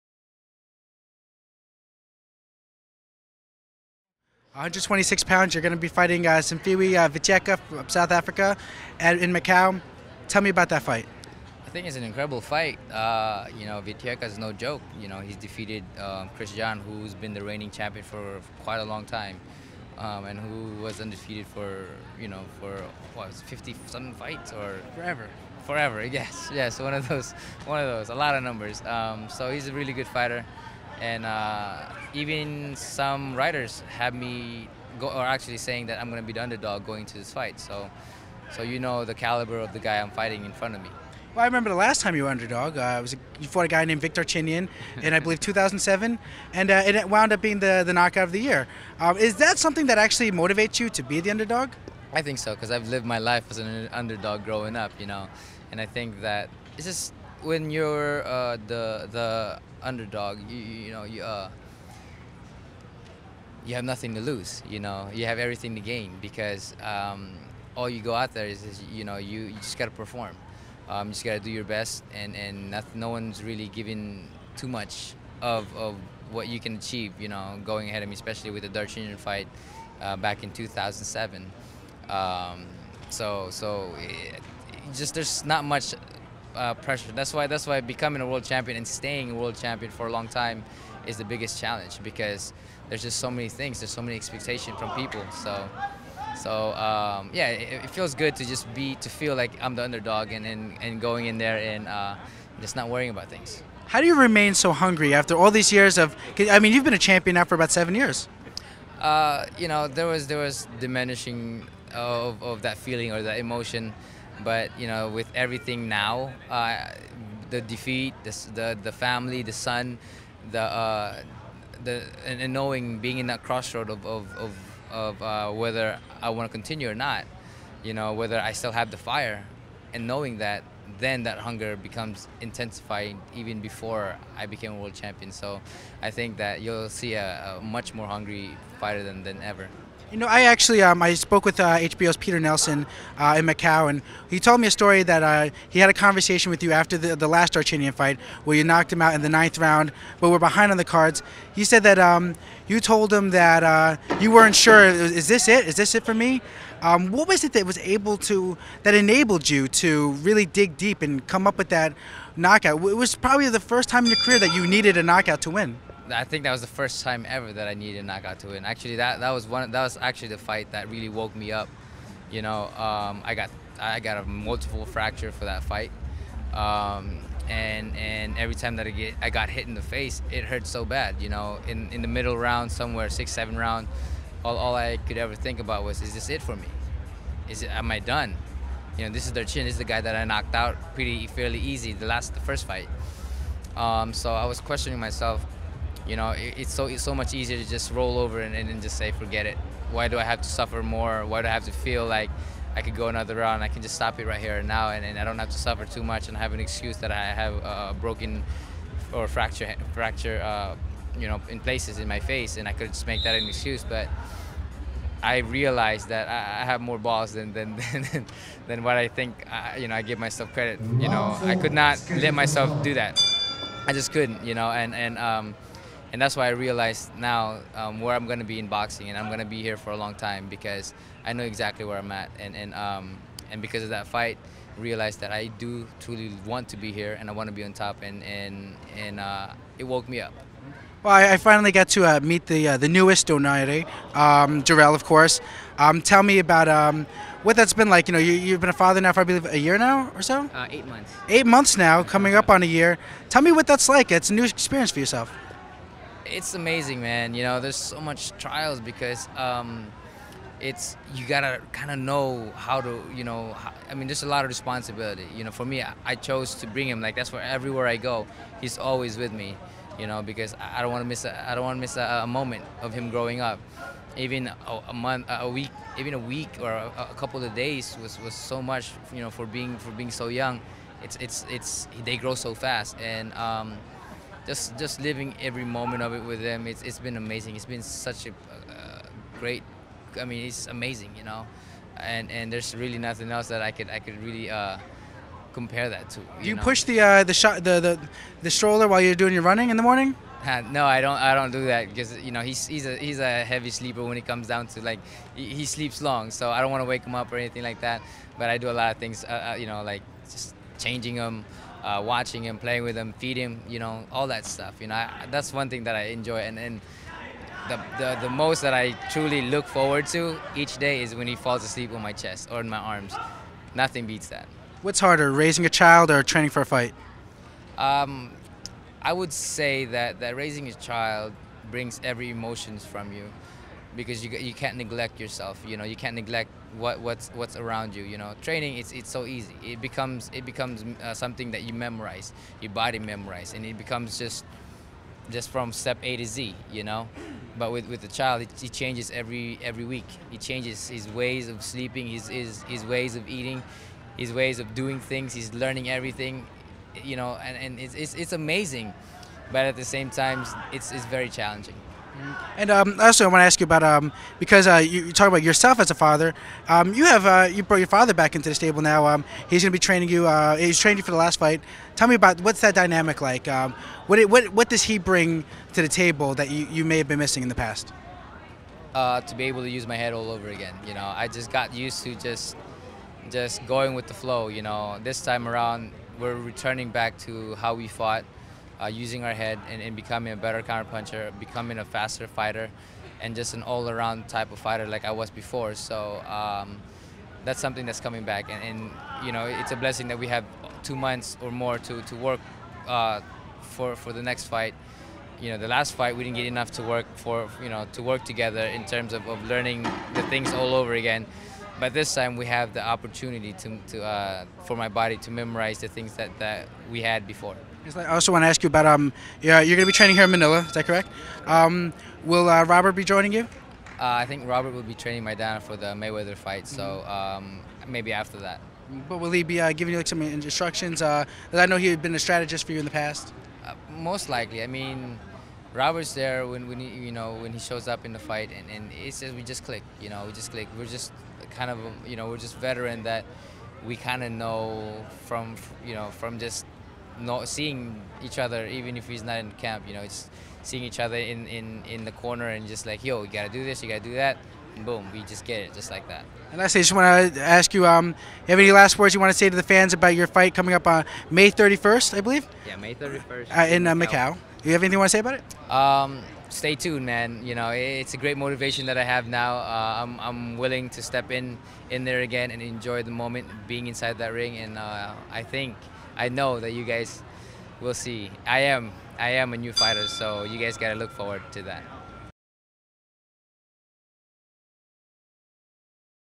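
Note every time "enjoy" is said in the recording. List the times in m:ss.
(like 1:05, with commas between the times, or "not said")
5:16, 7:52.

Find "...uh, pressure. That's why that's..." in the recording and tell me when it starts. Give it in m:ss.
1:26.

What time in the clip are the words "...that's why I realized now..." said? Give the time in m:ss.
3:46.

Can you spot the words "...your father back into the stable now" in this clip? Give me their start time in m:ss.
6:07.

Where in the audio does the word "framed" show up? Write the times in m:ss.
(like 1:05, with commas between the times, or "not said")
not said.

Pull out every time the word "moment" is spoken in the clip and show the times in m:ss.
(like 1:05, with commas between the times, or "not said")
4:32, 4:45, 7:53.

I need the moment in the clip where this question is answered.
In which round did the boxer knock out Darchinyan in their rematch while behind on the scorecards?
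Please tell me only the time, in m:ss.
2:29.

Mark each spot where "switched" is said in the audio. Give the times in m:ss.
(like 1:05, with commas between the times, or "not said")
not said.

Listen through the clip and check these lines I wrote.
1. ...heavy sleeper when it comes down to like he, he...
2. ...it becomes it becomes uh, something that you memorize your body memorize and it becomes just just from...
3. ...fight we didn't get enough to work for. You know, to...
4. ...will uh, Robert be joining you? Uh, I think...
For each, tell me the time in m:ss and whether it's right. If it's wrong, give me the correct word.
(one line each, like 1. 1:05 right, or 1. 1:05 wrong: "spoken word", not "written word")
1. 5:03 right
2. 5:39 right
3. 6:45 right
4. 7:02 right.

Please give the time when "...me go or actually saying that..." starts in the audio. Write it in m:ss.
0:34.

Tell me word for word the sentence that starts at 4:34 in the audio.
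Even a, a, month, a week, even a week or a, a couple of days was, was so much.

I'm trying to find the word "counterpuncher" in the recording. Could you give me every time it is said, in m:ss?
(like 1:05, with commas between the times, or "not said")
6:30.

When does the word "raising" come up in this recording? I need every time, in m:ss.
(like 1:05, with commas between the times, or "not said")
5:25, 5:30.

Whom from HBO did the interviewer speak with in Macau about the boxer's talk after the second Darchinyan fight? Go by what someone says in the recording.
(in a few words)
Peter Nelson.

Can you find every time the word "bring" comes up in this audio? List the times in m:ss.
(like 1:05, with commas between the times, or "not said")
4:26, 5:31, 6:14.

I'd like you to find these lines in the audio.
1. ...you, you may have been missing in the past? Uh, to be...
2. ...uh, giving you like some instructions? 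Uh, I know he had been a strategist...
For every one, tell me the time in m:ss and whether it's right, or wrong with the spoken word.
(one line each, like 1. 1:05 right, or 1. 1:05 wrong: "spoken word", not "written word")
1. 6:16 right
2. 7:09 right.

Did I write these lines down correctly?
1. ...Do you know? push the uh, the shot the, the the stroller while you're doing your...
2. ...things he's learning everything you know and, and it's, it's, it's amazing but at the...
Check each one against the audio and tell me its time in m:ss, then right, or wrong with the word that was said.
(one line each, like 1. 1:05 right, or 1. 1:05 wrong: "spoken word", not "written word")
1. 4:56 right
2. 5:54 right.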